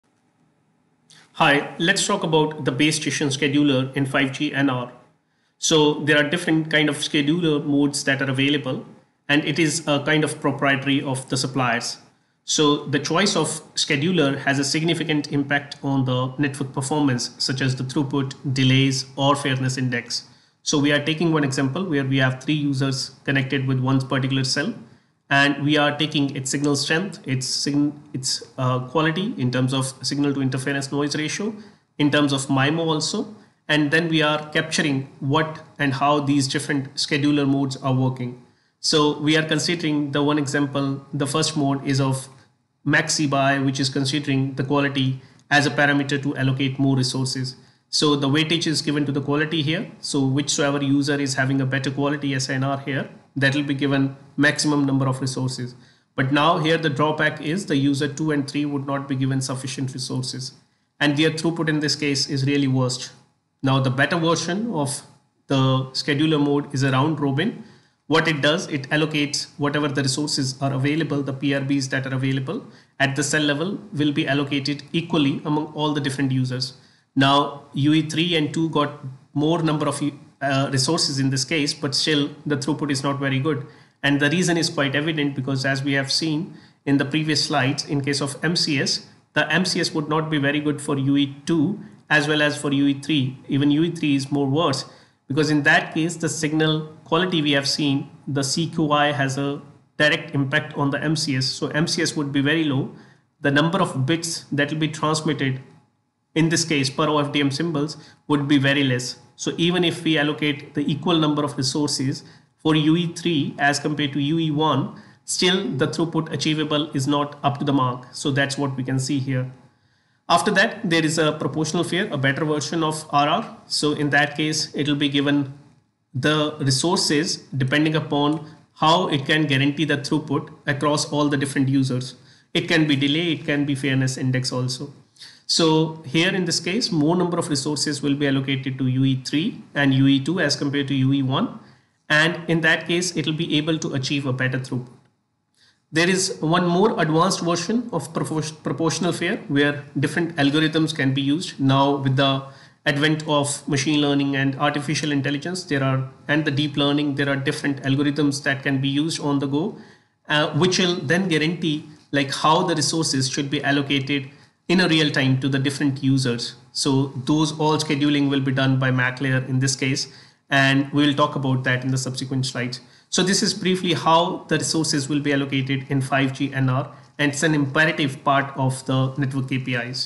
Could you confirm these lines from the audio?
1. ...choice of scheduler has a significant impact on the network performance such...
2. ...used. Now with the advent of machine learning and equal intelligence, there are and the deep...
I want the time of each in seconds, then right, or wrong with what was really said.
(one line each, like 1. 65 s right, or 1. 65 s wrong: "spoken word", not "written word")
1. 12 s right
2. 151 s wrong: "artificial", not "equal".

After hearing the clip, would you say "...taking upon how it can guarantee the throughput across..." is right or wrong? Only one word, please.
wrong.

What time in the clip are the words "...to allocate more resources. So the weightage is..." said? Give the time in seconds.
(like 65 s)
46 s.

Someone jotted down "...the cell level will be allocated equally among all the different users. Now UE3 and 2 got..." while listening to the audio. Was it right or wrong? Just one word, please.
right.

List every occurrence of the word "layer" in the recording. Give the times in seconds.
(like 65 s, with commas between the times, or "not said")
169 s.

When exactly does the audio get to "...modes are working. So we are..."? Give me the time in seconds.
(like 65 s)
37 s.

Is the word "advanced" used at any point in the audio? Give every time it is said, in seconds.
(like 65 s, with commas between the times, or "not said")
147 s.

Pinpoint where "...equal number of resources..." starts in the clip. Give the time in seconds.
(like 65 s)
110 s.